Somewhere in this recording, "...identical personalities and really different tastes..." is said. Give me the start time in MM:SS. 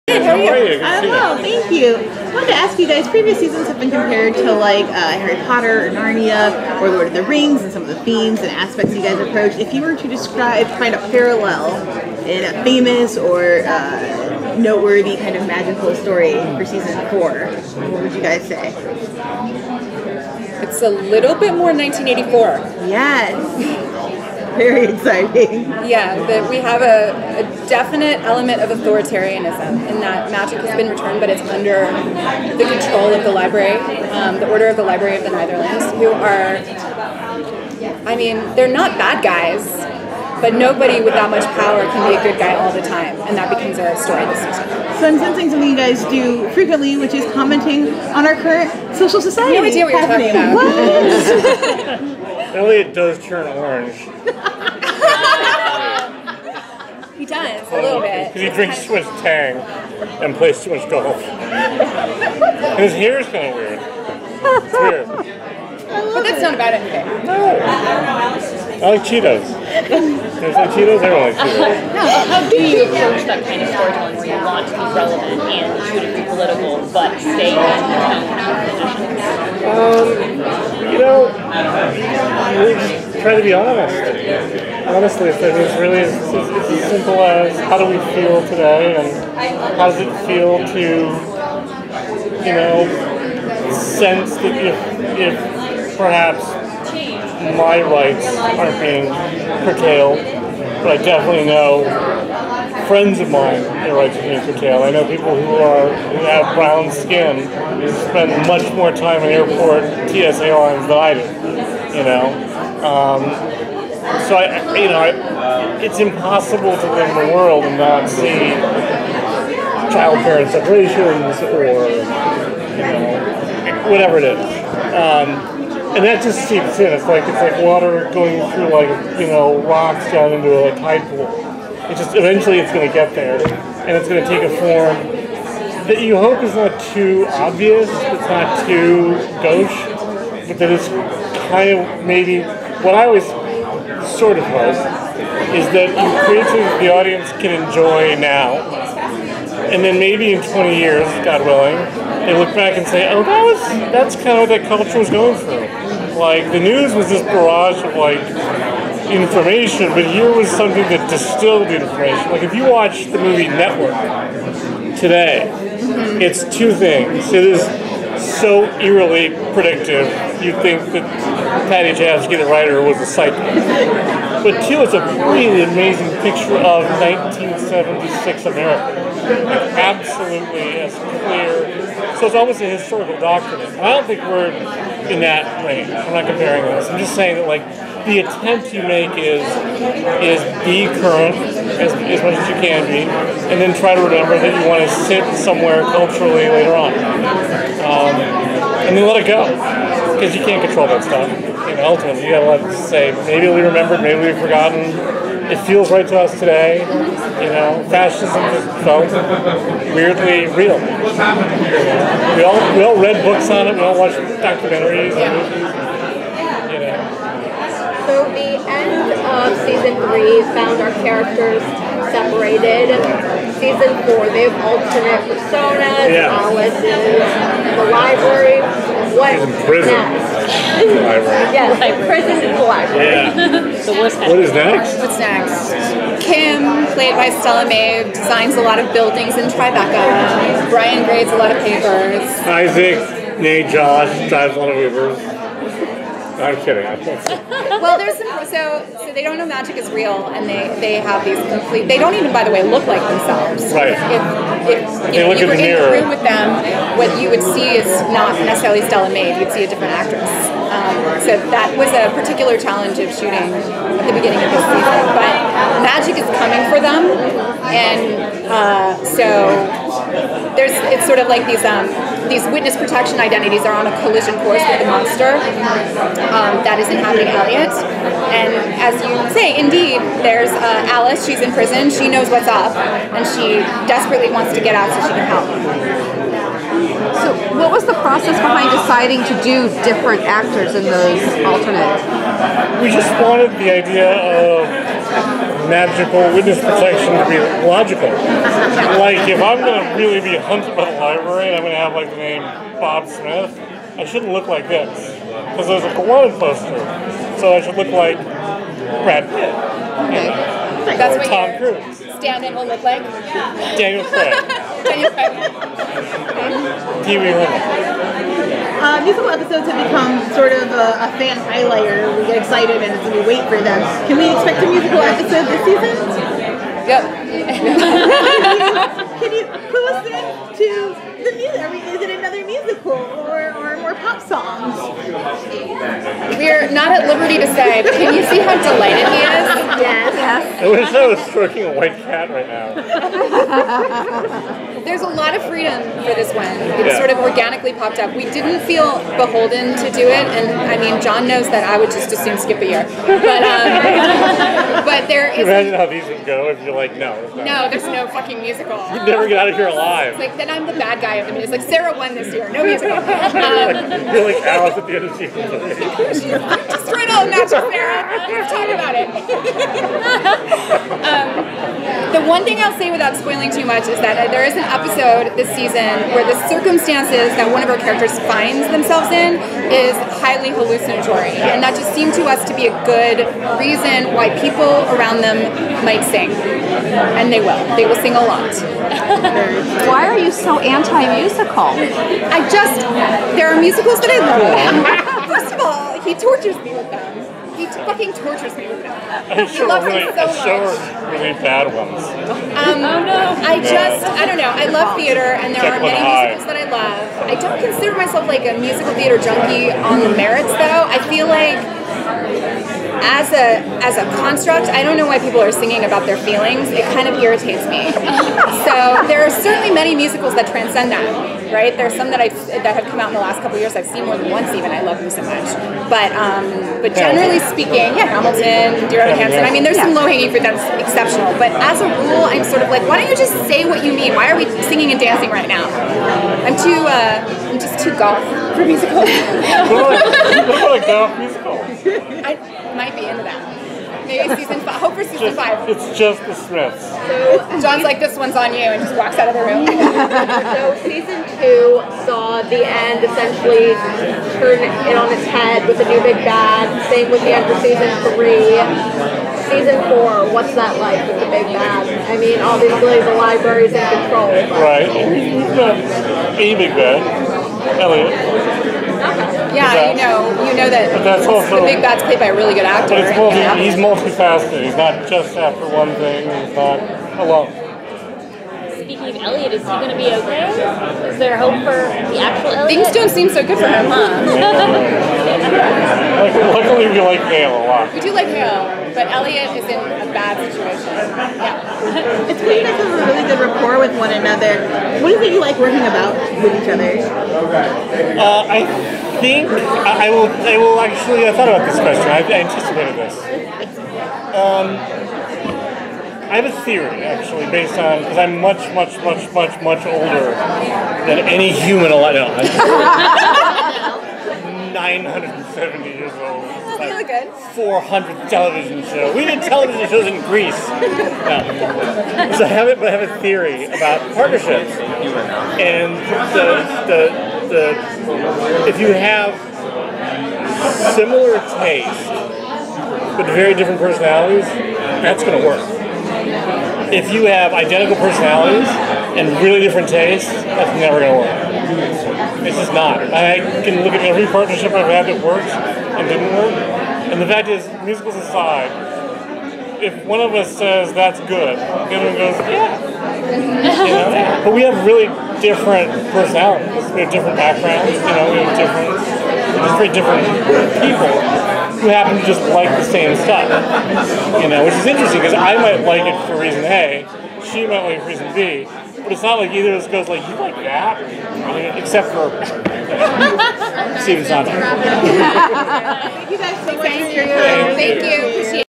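08:57.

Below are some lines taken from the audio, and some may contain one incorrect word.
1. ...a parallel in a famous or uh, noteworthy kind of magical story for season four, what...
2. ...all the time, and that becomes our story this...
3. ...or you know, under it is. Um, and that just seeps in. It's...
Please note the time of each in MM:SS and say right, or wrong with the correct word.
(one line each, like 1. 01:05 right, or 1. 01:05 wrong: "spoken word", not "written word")
1. 00:10 right
2. 00:42 right
3. 02:01 wrong: "whatever", not "under".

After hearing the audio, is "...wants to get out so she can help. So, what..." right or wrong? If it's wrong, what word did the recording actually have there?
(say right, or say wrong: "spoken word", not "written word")
right.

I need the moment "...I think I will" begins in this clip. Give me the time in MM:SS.
08:18.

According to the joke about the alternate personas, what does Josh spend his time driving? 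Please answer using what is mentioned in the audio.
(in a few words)
Ubers.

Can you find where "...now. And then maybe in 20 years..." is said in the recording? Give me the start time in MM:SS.
02:28.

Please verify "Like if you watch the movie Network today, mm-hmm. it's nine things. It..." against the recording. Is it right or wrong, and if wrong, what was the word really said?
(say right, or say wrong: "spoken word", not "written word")
wrong: "two", not "nine".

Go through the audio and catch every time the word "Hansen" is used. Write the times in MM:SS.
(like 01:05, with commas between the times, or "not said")
07:09.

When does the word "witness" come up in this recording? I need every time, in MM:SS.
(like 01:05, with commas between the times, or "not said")
04:32, 04:56.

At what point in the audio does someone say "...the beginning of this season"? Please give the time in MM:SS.
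04:24.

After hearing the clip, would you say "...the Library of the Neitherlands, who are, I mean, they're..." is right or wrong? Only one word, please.
right.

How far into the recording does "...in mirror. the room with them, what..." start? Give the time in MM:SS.
04:15.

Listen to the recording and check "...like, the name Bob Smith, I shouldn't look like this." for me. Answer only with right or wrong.
right.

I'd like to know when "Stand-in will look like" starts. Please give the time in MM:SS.
05:12.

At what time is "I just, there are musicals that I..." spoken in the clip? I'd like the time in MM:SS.
06:32.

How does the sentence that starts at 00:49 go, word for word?
No idea what you're talking about.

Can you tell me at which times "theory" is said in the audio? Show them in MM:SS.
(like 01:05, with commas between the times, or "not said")
08:26, 08:43.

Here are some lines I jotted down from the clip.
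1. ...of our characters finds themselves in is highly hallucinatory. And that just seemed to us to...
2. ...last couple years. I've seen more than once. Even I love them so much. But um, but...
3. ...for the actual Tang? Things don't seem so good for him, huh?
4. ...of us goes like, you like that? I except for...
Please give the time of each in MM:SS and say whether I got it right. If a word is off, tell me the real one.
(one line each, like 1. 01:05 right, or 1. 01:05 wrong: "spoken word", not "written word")
1. 06:17 right
2. 07:03 right
3. 08:01 wrong: "Eliot", not "Tang"
4. 09:29 right.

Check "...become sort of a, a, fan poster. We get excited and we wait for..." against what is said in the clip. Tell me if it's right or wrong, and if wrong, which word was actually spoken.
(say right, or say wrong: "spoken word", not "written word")
wrong: "highlighter", not "poster".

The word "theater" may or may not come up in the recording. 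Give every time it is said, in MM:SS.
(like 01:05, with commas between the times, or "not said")
06:44, 06:48.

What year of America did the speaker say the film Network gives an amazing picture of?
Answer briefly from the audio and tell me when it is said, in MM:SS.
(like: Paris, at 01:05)
1976, at 02:56.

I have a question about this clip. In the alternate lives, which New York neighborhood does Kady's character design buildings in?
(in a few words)
Tribeca.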